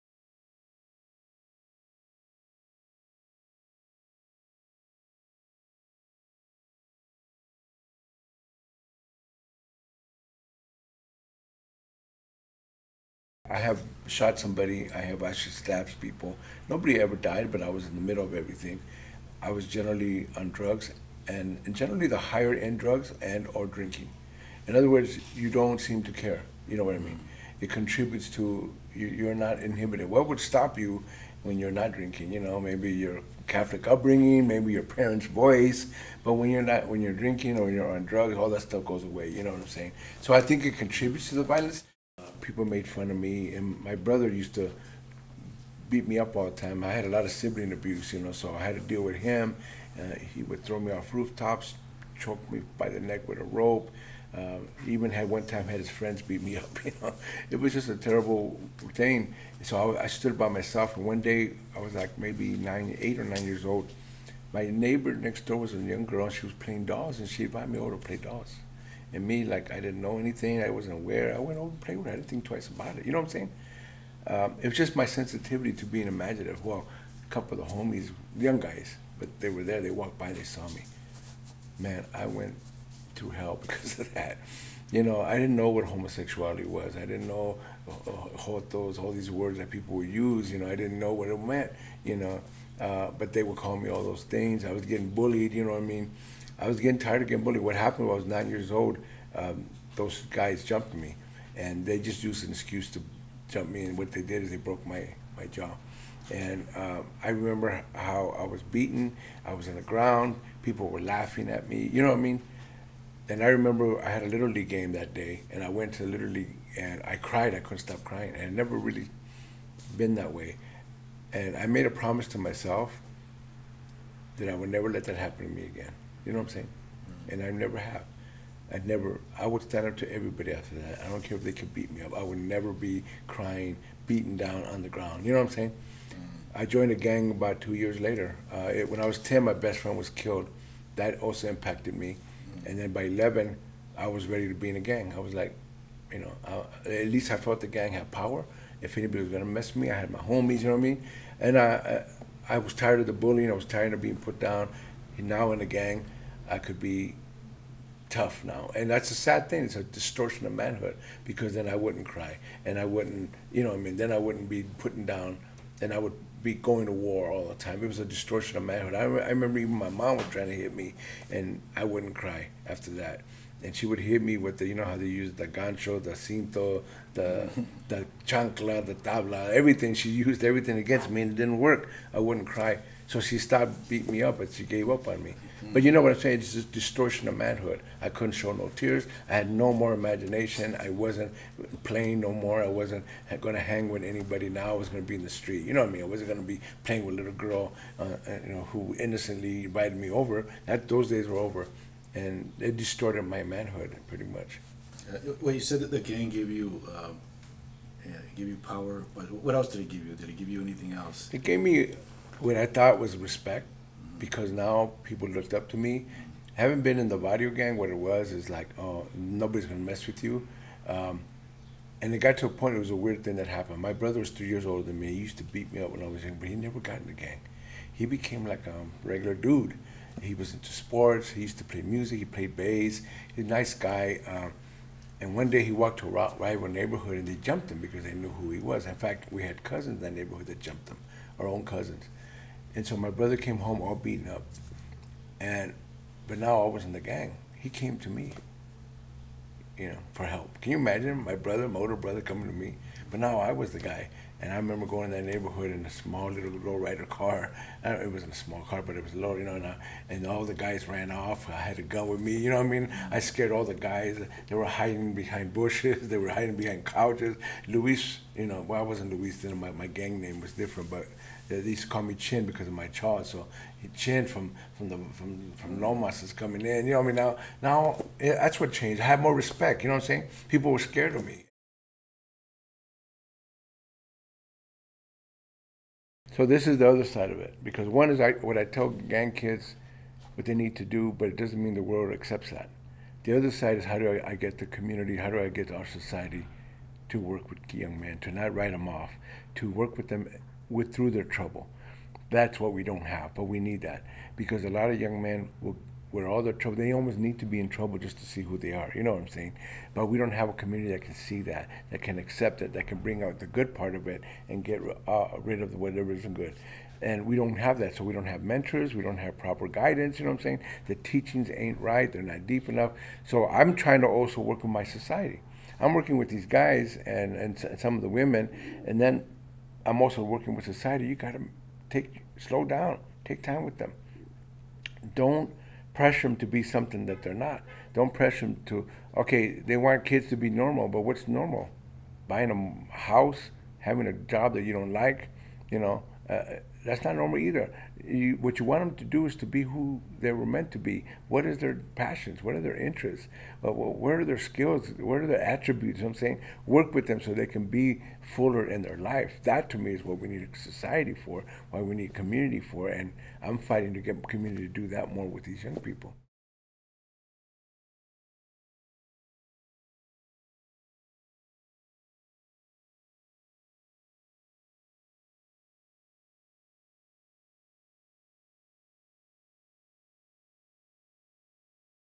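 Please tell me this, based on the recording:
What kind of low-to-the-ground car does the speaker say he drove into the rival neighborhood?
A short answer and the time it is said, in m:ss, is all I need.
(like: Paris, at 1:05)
rider car, at 4:16.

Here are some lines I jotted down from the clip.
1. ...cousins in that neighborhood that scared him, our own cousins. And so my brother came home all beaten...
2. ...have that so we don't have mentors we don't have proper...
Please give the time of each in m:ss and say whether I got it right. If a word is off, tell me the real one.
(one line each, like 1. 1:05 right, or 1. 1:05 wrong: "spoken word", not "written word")
1. 3:59 wrong: "jumped", not "scared"
2. 5:17 right.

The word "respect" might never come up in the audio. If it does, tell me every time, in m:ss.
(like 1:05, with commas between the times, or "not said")
3:33, 4:39.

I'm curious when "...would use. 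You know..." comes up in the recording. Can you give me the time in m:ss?
1:29.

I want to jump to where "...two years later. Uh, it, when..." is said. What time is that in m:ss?
2:17.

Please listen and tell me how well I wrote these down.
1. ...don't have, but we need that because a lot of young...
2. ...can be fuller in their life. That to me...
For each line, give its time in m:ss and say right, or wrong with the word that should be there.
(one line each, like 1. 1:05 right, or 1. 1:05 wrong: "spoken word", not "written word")
1. 5:02 right
2. 5:57 right.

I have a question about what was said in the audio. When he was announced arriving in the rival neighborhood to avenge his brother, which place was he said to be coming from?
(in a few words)
Lomas.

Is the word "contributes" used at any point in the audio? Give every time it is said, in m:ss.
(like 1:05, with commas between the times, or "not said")
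0:27, 0:40.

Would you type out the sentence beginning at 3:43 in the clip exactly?
My brother was three years older than me.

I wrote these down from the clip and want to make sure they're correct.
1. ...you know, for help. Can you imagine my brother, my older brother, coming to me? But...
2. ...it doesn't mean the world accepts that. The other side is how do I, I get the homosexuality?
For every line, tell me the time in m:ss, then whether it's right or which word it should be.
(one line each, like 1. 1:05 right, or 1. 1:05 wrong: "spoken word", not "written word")
1. 4:09 right
2. 4:51 wrong: "community", not "homosexuality".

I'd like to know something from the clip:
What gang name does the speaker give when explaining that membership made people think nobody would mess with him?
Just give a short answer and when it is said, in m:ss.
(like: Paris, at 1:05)
Vario, at 3:37.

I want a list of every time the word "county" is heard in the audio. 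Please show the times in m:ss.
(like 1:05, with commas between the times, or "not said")
not said.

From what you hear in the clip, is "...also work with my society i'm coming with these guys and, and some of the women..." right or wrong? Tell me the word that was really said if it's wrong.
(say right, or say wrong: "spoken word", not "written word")
wrong: "working", not "coming".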